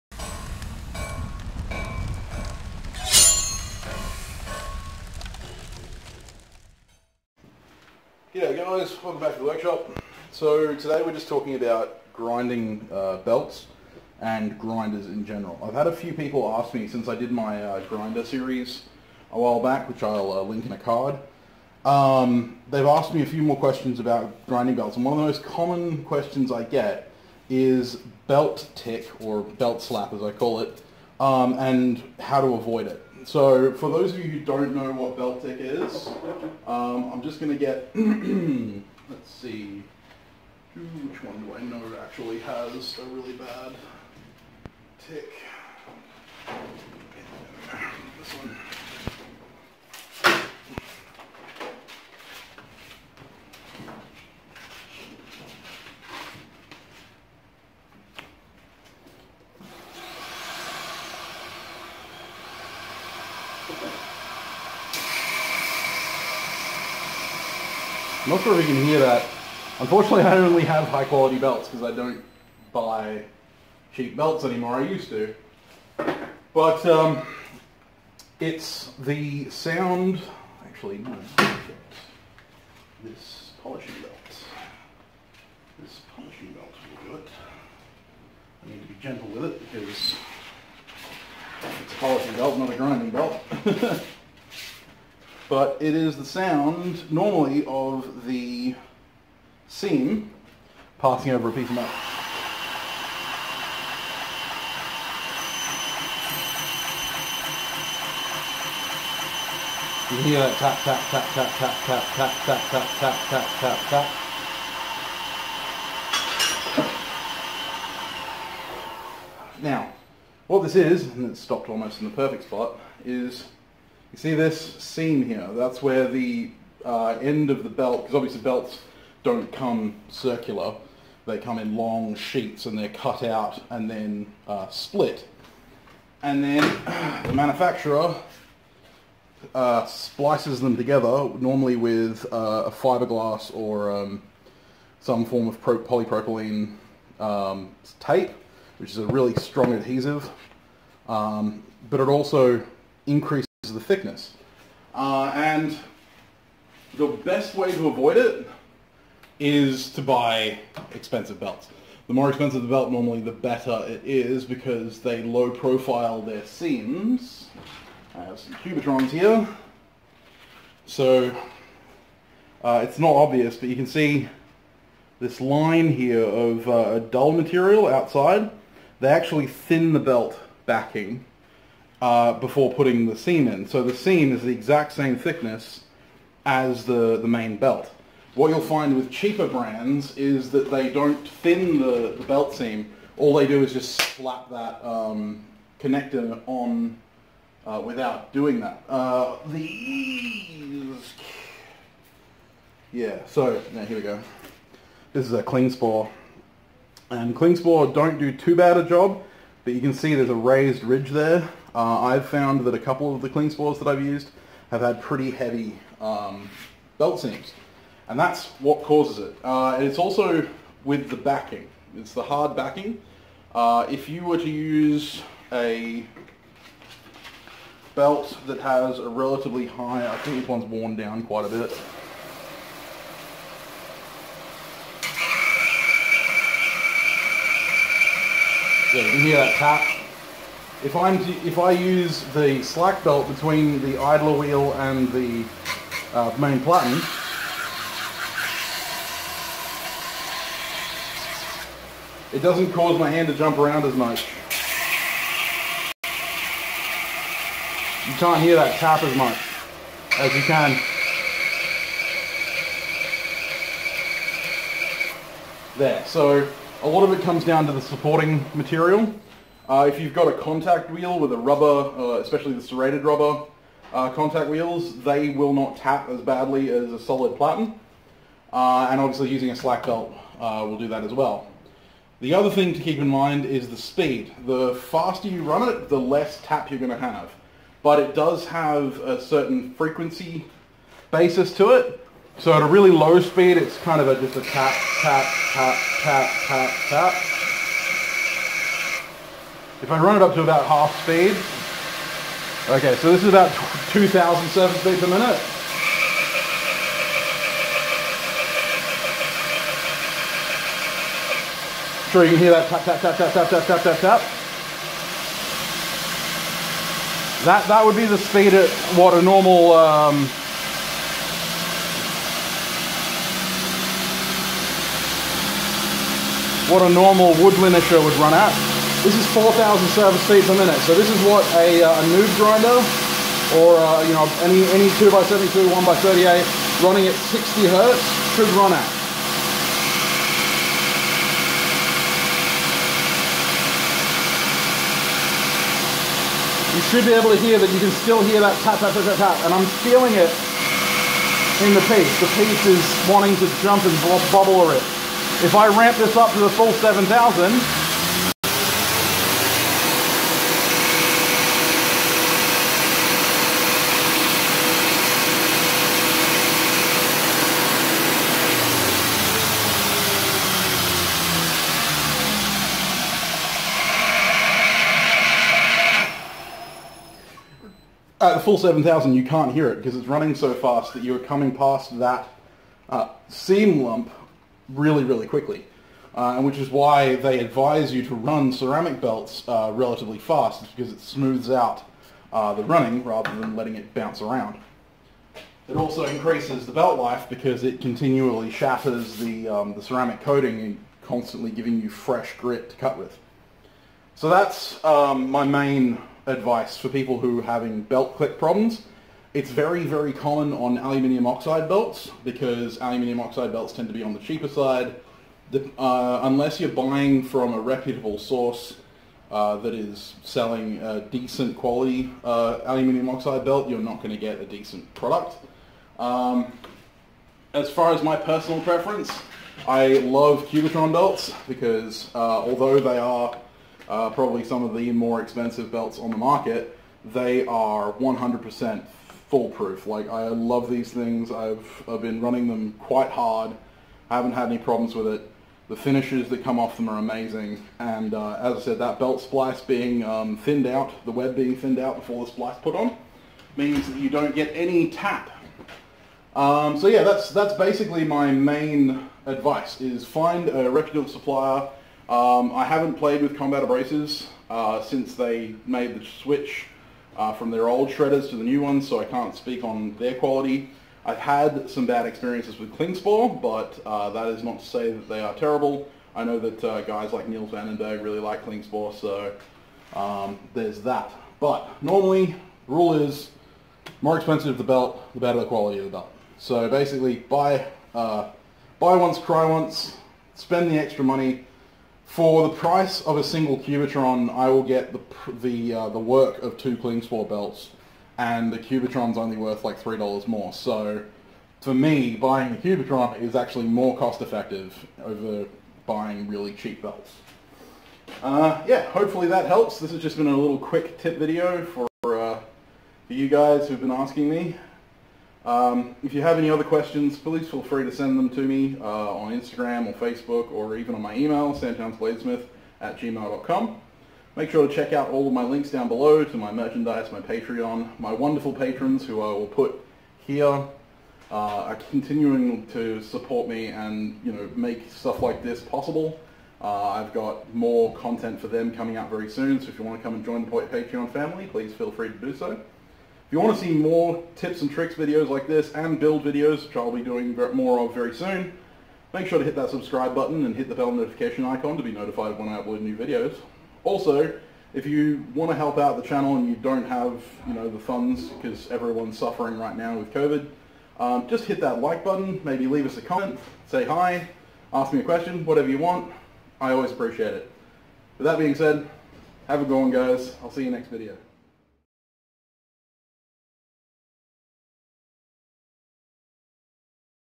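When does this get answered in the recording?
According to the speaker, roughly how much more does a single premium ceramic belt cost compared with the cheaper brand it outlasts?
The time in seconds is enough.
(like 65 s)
499 s.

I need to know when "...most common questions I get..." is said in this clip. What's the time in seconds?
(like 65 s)
25 s.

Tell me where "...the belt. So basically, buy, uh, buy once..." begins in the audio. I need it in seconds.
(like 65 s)
485 s.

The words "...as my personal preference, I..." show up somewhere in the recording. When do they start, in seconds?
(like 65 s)
427 s.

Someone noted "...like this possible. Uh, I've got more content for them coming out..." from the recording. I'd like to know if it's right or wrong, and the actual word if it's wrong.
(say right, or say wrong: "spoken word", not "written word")
right.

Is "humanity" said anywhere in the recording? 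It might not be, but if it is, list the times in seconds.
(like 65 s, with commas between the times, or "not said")
not said.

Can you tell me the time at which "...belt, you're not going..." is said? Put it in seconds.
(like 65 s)
423 s.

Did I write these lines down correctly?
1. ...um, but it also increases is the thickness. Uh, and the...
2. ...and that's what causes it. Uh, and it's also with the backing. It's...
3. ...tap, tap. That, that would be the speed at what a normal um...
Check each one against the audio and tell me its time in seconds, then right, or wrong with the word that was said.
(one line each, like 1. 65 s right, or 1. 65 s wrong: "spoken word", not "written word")
1. 151 s right
2. 218 s right
3. 313 s right.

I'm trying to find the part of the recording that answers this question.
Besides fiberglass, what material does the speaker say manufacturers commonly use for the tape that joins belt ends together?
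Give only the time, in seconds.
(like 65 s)
145 s.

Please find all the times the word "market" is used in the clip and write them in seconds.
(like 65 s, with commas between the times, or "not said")
436 s.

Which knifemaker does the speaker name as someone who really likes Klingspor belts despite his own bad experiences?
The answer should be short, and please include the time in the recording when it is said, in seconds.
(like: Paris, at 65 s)
Niels Vandenberg, at 477 s.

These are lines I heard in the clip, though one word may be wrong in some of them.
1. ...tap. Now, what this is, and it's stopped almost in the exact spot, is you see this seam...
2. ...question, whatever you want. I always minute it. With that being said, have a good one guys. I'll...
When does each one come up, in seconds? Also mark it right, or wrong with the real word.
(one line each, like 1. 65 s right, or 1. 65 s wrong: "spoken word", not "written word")
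1. 113 s wrong: "perfect", not "exact"
2. 565 s wrong: "appreciate", not "minute".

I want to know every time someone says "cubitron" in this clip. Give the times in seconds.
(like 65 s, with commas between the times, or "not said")
168 s, 430 s, 493 s, 498 s, 502 s.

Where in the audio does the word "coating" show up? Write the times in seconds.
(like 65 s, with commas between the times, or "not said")
400 s.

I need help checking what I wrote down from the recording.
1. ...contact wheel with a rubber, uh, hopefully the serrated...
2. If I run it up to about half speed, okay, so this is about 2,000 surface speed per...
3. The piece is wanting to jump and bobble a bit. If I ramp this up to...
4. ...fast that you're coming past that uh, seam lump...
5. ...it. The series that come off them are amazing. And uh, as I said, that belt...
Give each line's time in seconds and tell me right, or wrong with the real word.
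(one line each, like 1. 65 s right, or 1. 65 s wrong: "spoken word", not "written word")
1. 270 s wrong: "especially", not "hopefully"
2. 299 s right
3. 352 s right
4. 380 s right
5. 445 s wrong: "finishes", not "series".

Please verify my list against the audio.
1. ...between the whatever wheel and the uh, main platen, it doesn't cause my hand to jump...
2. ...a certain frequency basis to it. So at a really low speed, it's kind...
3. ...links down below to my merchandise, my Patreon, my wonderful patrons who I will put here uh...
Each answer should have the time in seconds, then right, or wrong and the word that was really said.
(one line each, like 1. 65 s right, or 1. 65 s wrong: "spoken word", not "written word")
1. 243 s wrong: "idler", not "whatever"
2. 288 s right
3. 525 s right.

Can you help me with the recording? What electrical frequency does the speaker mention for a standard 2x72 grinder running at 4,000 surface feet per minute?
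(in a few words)
60 hertz.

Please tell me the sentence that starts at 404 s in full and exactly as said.
So that's um, my main advice for people who are having belt click problems.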